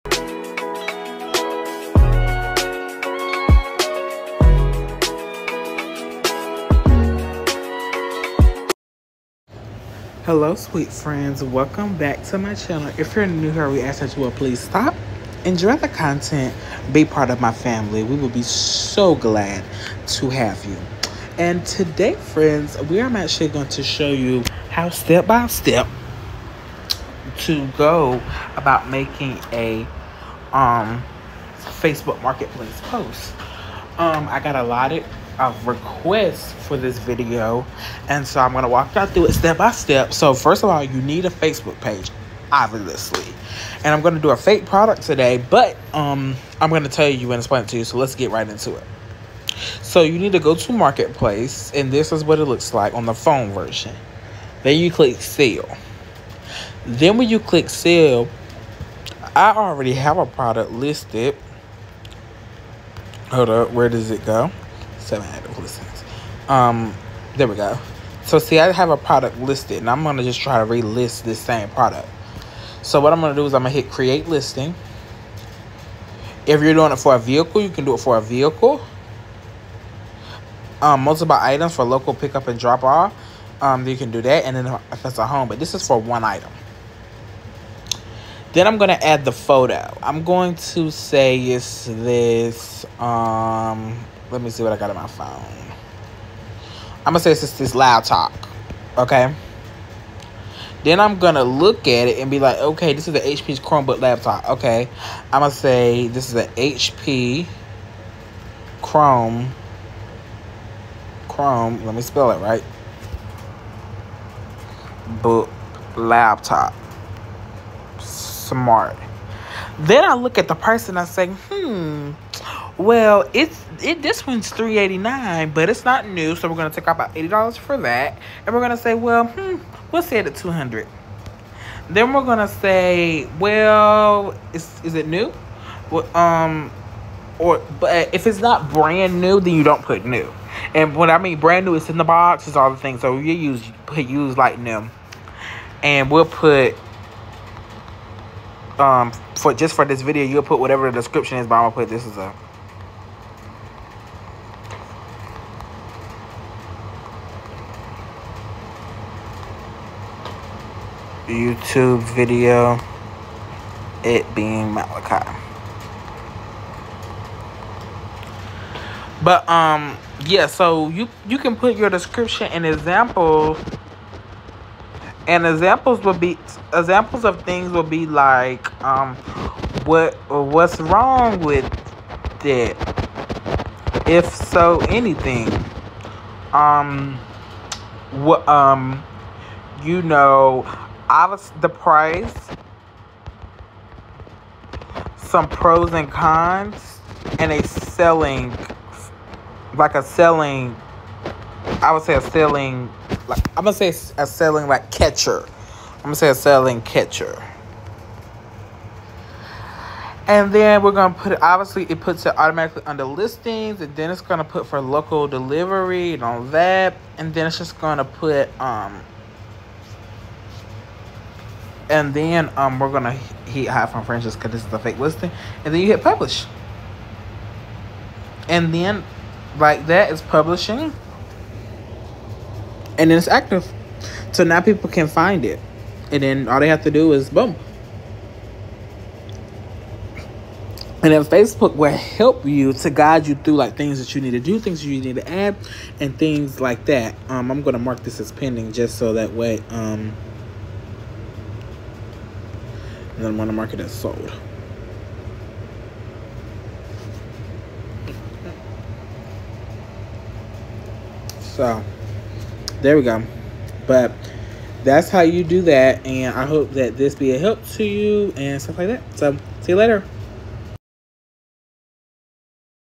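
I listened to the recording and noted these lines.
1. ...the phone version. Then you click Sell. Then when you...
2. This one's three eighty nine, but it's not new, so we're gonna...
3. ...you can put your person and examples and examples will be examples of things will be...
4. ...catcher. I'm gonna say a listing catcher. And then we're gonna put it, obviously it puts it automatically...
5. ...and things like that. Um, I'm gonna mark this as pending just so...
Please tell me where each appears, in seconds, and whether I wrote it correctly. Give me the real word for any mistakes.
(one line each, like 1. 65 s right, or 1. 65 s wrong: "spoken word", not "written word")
1. 53 s right
2. 124 s right
3. 171 s wrong: "description", not "person"
4. 204 s wrong: "selling", not "listing"
5. 245 s right.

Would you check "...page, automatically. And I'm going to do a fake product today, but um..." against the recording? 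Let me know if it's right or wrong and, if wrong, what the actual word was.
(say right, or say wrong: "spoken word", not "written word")
wrong: "obviously", not "automatically".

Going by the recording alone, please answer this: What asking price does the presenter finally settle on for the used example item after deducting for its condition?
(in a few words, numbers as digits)
$200.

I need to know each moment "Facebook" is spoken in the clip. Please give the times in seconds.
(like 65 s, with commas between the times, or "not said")
31 s, 41 s, 241 s.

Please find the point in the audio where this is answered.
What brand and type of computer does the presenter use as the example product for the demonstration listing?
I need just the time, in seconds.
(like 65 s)
103 s.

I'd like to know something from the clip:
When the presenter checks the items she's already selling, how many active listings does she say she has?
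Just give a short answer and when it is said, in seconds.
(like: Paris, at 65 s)
7, at 65 s.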